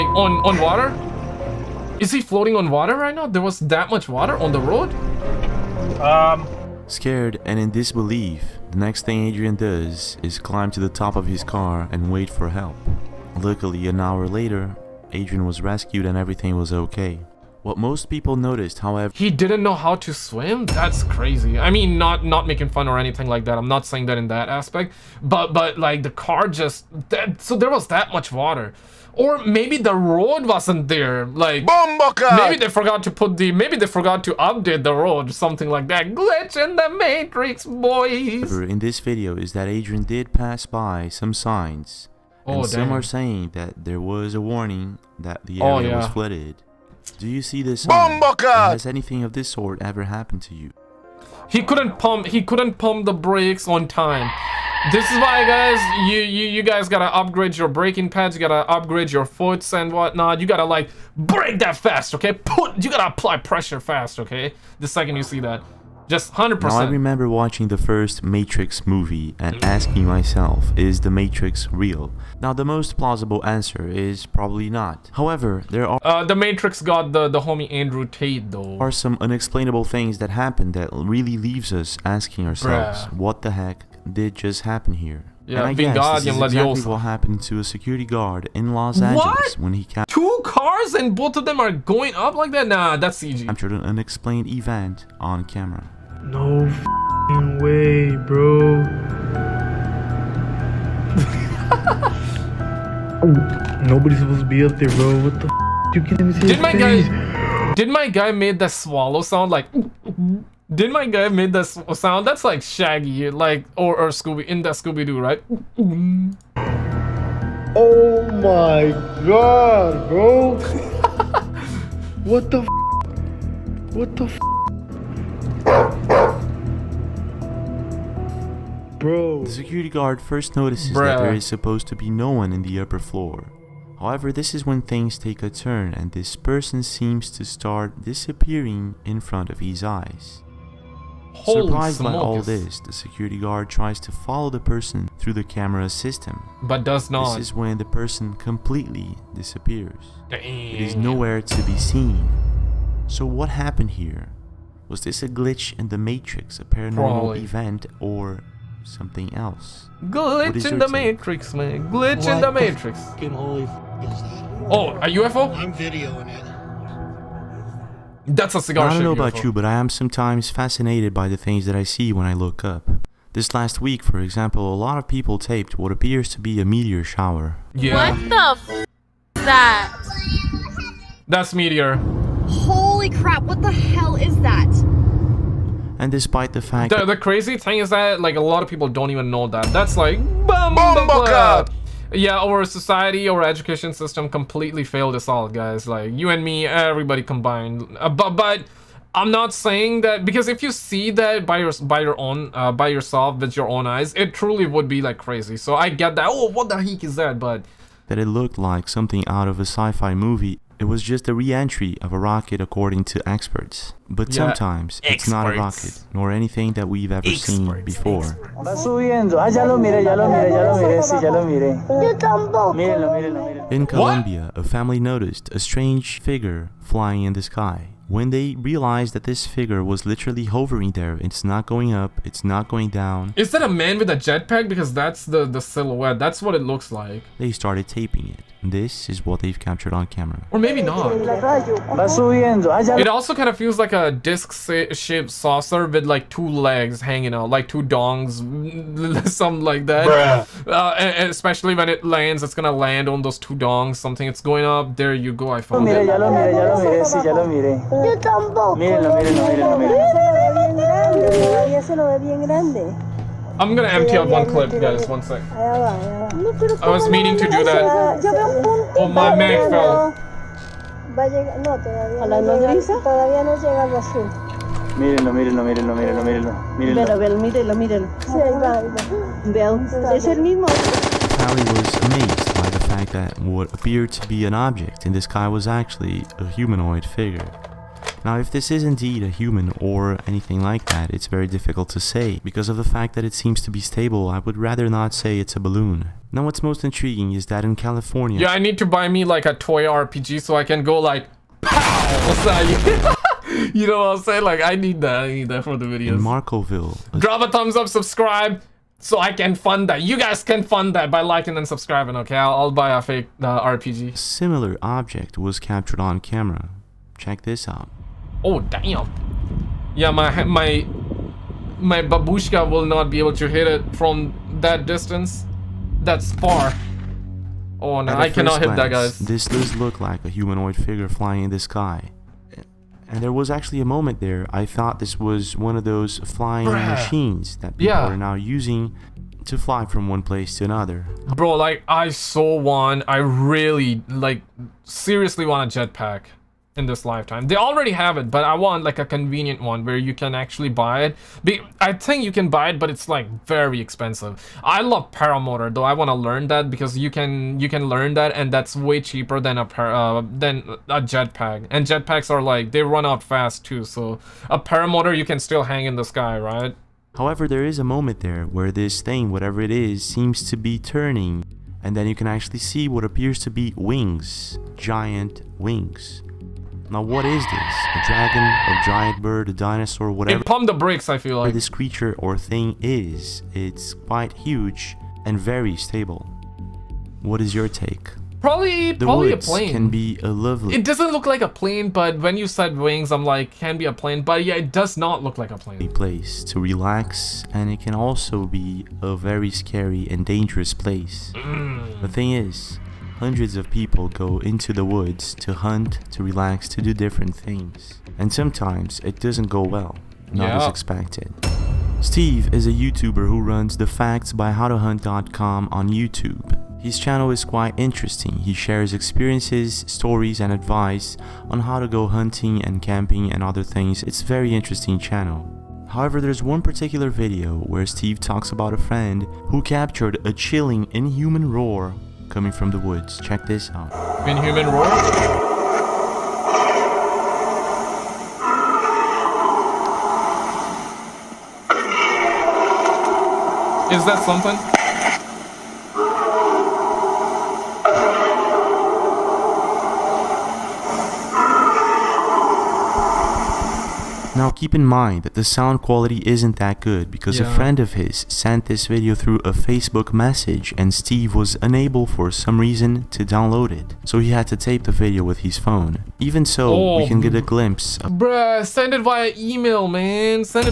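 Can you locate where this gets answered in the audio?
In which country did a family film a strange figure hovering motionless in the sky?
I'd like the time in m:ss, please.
3:43.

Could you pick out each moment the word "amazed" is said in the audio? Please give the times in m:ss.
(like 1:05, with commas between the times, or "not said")
4:42.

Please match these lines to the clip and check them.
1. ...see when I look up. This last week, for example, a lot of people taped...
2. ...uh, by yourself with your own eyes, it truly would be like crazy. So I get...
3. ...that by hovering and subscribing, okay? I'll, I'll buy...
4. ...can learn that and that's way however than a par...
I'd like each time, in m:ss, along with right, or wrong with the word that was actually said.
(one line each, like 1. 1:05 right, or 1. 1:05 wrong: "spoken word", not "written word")
1. 2:51 right
2. 3:22 right
3. 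5:10 wrong: "liking", not "hovering"
4. 5:57 wrong: "cheaper", not "however".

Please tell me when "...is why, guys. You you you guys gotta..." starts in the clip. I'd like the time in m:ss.
0:55.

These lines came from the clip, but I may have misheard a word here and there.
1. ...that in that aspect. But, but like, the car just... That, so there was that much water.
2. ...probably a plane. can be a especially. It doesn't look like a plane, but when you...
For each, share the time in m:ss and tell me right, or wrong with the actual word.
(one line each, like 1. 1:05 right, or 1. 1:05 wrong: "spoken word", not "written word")
1. 0:24 right
2. 6:29 wrong: "lovely", not "especially".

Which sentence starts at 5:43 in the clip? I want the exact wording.
I really like seriously want a jetpack in this lifetime.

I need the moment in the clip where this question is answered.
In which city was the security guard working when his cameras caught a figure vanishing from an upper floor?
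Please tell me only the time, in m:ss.
1:28.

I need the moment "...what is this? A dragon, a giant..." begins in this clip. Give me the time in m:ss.
6:17.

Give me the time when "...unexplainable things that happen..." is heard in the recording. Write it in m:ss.
1:19.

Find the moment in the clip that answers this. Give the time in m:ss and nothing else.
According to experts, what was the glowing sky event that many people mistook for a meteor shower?
3:31.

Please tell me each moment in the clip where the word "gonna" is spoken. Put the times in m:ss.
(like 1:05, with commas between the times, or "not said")
4:12, 4:23.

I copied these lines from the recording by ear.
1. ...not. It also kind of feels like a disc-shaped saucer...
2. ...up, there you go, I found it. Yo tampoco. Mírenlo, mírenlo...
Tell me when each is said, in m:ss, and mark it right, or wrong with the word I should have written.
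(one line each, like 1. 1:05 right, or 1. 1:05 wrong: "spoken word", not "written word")
1. 4:00 right
2. 4:14 right.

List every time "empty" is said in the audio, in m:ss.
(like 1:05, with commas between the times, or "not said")
4:23.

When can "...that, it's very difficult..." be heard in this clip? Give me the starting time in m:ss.
4:50.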